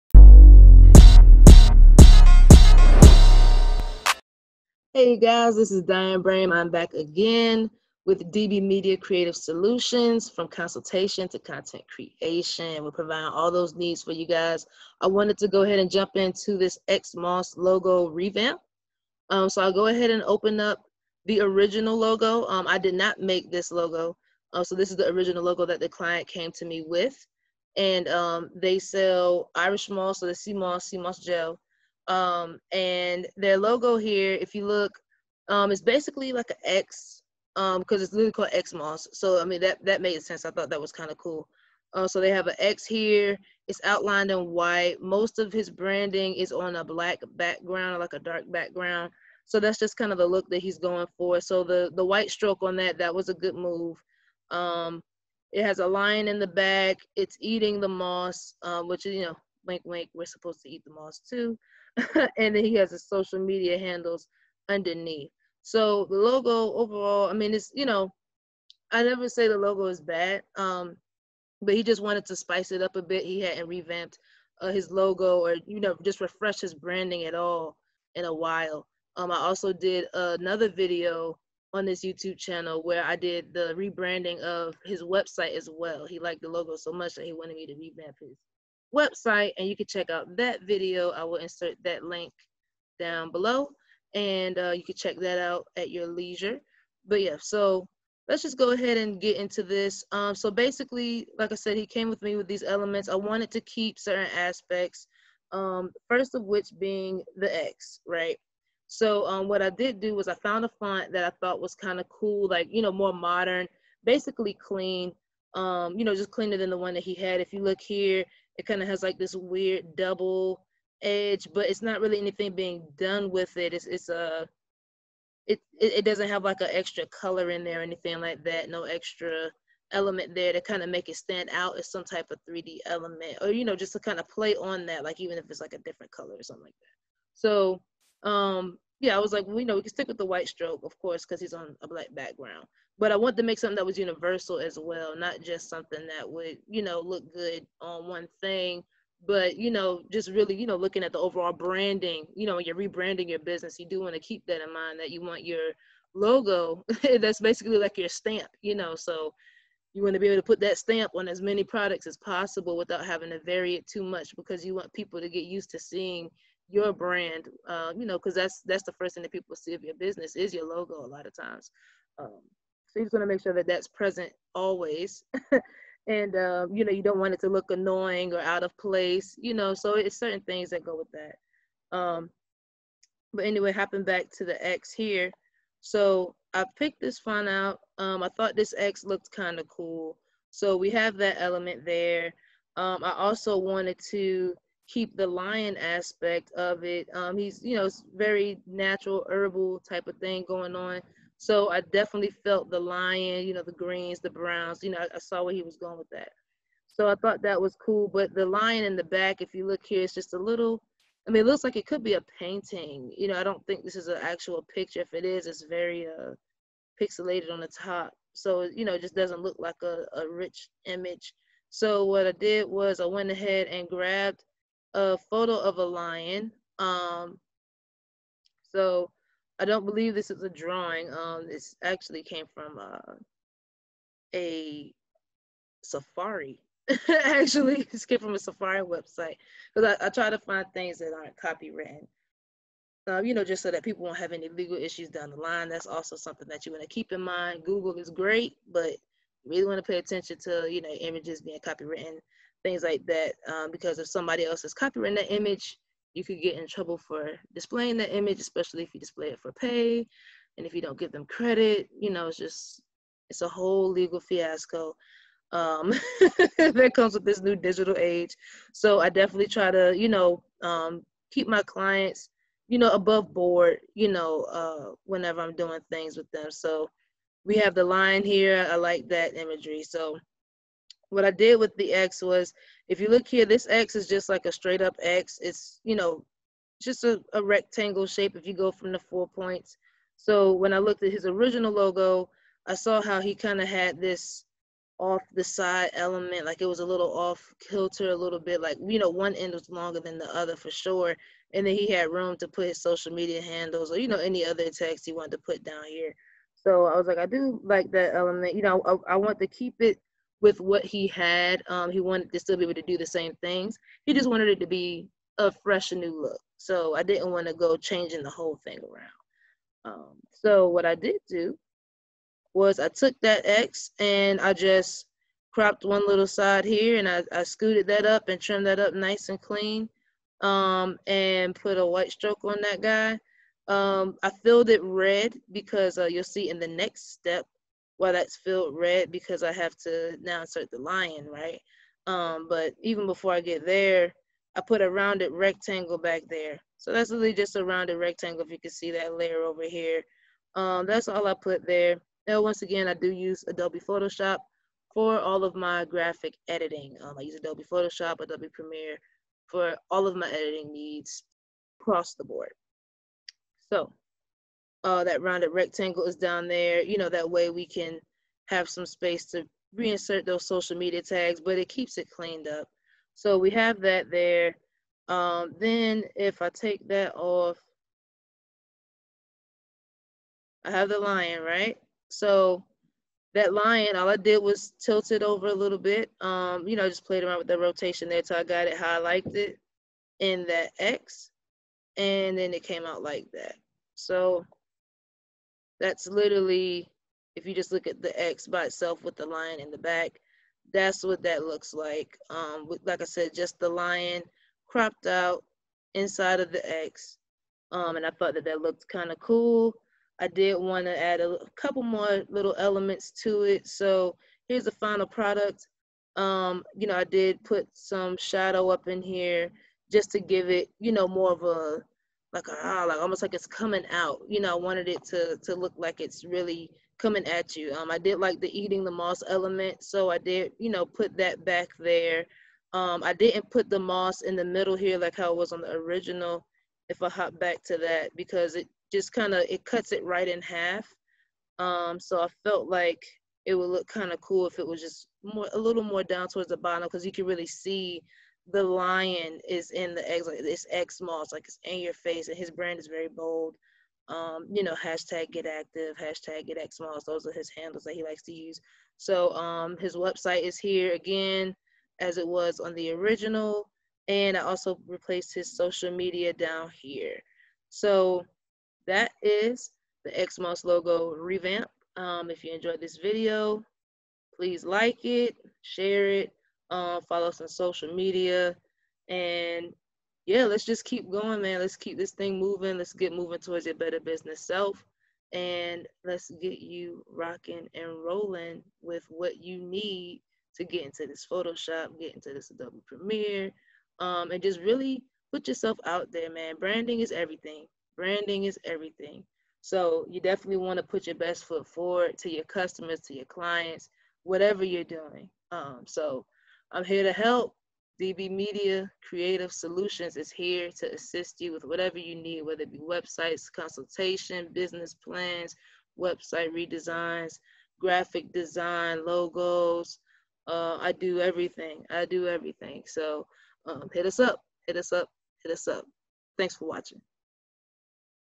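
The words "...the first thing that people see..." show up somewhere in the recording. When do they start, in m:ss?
2:48.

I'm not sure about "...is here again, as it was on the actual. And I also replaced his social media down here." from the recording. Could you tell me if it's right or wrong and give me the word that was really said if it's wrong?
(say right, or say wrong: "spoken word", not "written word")
wrong: "original", not "actual".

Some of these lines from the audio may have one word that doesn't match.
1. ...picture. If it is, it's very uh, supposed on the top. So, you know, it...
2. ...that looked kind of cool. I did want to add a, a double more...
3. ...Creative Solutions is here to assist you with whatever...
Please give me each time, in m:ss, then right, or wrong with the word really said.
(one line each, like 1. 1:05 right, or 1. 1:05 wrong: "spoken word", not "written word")
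1. 3:34 wrong: "pixelated", not "supposed"
2. 6:48 wrong: "couple", not "double"
3. 8:29 right.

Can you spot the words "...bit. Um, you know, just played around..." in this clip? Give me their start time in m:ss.
6:25.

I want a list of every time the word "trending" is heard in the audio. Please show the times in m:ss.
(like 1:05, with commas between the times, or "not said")
not said.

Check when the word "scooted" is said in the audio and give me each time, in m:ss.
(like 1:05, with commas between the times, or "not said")
5:27.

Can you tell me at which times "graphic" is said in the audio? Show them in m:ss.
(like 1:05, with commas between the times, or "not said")
5:55, 8:37.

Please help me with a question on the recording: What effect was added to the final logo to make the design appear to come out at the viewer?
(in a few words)
Shadow.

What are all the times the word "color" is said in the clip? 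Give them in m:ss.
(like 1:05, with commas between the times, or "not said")
2:07, 2:16.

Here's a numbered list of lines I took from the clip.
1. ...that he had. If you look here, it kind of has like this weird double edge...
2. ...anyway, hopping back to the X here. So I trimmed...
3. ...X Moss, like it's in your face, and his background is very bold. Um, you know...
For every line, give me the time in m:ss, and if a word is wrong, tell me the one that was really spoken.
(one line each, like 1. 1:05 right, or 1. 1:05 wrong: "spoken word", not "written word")
1. 1:56 right
2. 3:03 wrong: "picked", not "trimmed"
3. 7:30 wrong: "brand", not "background".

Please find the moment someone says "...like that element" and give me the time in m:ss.
5:07.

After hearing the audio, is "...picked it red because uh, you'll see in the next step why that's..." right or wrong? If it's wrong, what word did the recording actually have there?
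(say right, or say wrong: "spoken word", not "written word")
wrong: "filled", not "picked".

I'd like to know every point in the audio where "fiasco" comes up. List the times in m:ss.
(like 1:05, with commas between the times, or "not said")
4:24.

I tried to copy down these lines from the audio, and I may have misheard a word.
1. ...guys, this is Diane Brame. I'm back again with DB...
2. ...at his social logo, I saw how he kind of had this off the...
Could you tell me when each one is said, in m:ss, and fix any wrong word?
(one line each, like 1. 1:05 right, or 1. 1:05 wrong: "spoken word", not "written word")
1. 0:05 right
2. 4:51 wrong: "original", not "social".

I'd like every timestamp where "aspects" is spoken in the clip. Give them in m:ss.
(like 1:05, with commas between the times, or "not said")
1:44, 3:15.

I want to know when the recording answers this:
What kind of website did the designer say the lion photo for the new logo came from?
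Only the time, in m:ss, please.
3:58.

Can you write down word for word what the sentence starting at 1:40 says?
Um, so basically, like I said, he came with me with these elements.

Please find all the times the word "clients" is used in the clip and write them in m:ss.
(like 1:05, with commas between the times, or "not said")
0:25, 4:31, 8:23.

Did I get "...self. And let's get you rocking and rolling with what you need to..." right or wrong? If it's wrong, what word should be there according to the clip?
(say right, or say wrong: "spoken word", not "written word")
right.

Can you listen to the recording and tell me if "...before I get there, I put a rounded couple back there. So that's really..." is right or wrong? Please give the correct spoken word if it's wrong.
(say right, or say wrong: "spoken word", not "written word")
wrong: "rectangle", not "couple".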